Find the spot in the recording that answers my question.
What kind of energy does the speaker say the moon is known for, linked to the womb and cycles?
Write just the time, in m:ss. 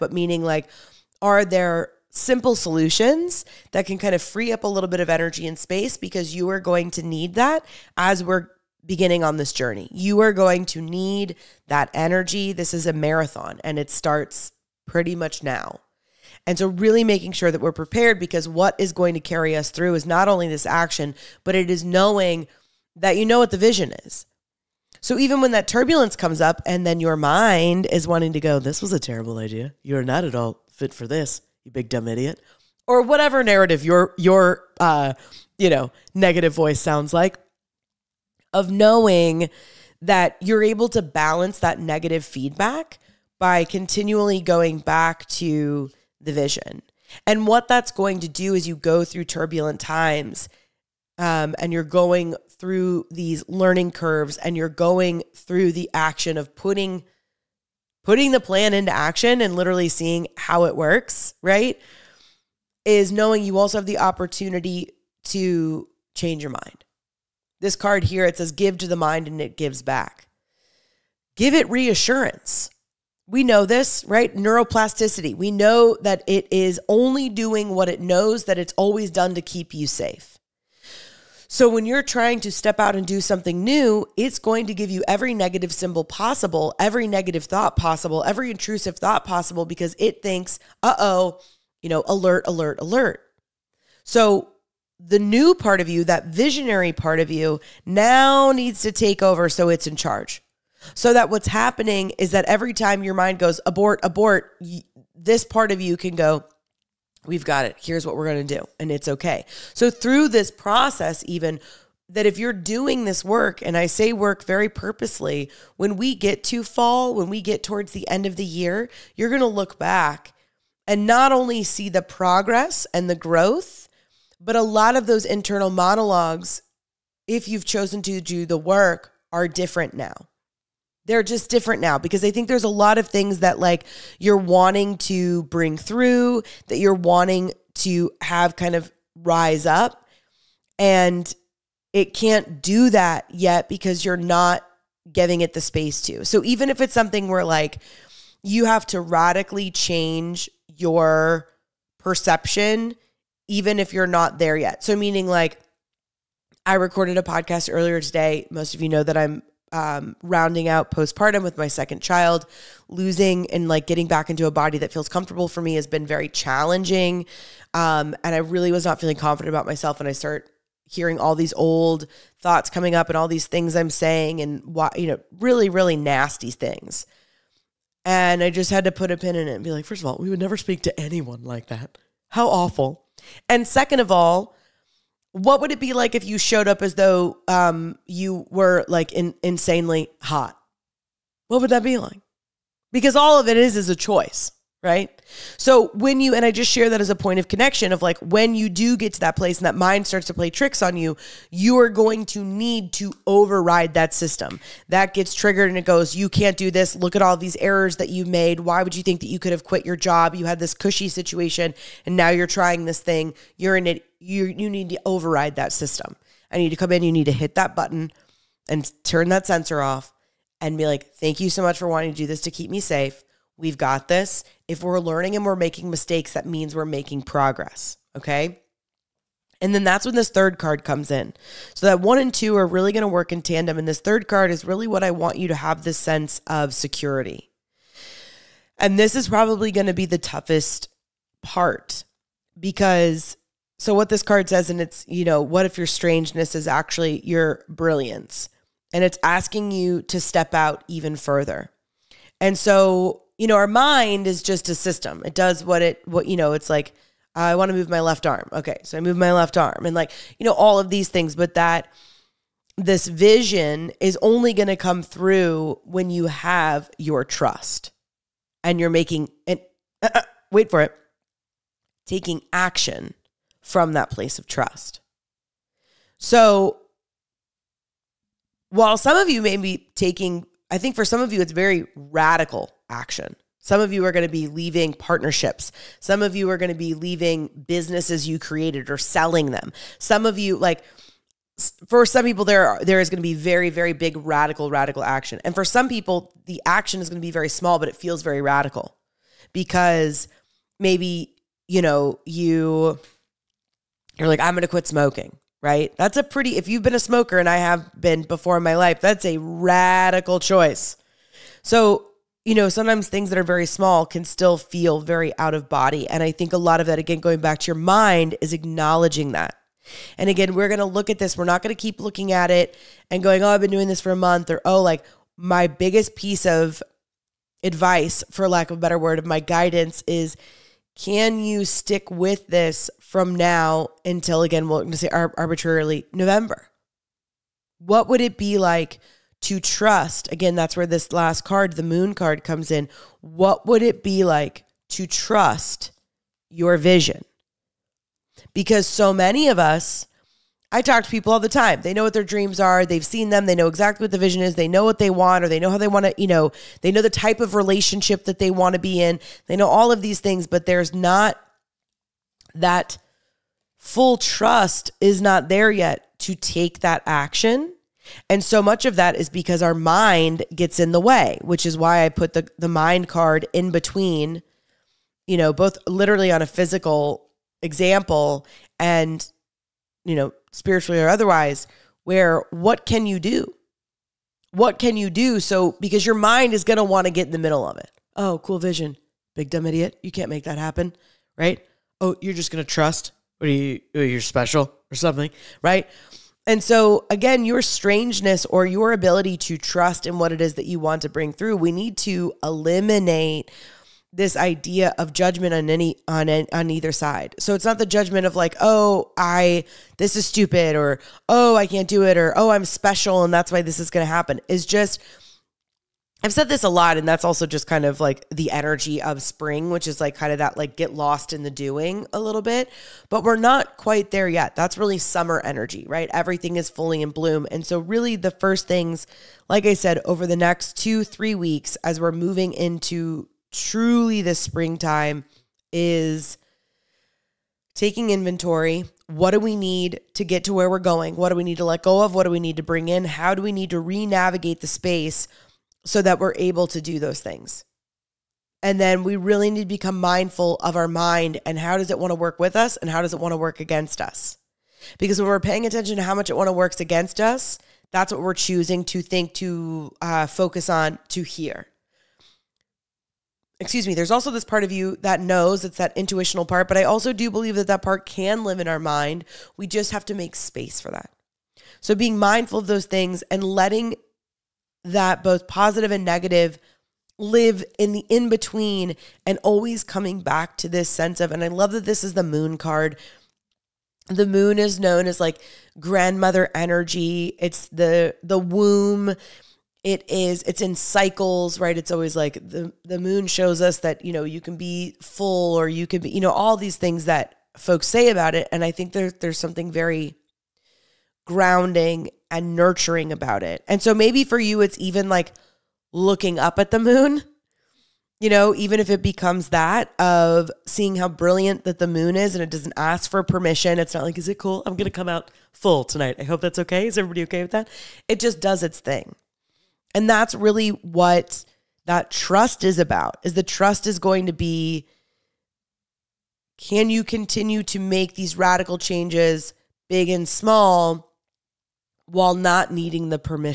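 8:05.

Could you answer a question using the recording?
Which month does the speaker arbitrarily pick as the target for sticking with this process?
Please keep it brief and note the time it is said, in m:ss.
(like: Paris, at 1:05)
November, at 5:36.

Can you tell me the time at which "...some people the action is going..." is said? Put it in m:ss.
4:55.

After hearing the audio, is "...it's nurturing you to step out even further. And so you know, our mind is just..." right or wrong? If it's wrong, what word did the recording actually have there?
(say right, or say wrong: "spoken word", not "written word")
wrong: "asking", not "nurturing".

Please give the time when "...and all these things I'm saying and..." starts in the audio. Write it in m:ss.
2:53.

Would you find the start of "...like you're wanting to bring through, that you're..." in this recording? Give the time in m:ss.
2:13.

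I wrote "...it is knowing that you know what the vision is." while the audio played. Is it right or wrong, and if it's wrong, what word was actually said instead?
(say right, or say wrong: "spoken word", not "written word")
right.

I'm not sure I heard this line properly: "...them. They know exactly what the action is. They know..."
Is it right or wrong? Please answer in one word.
wrong.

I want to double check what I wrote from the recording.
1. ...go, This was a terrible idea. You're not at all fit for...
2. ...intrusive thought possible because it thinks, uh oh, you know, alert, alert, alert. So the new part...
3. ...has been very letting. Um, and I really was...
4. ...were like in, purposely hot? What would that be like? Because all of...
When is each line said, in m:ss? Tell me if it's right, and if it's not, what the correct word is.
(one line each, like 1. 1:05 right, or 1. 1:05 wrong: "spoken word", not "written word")
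1. 0:28 right
2. 1:28 right
3. 2:45 wrong: "challenging", not "letting"
4. 3:08 wrong: "insanely", not "purposely".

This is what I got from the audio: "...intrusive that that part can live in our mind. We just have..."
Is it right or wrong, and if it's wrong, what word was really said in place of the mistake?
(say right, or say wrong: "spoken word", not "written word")
wrong: "believe", not "intrusive".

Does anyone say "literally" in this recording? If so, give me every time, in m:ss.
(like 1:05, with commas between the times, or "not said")
0:59, 6:15.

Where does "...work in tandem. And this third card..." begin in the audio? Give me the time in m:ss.
3:53.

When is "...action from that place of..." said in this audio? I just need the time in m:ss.
4:32.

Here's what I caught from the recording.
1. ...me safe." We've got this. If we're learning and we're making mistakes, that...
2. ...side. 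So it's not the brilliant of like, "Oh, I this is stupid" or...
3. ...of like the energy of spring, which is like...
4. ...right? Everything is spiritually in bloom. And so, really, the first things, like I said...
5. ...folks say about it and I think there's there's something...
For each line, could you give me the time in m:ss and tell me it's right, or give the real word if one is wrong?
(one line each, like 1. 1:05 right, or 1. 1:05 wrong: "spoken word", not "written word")
1. 3:42 right
2. 6:46 wrong: "judgment", not "brilliant"
3. 6:57 right
4. 7:05 wrong: "fully", not "spiritually"
5. 8:17 right.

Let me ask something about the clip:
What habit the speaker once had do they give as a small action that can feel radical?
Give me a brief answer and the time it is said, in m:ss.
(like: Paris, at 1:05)
Smoking, at 5:04.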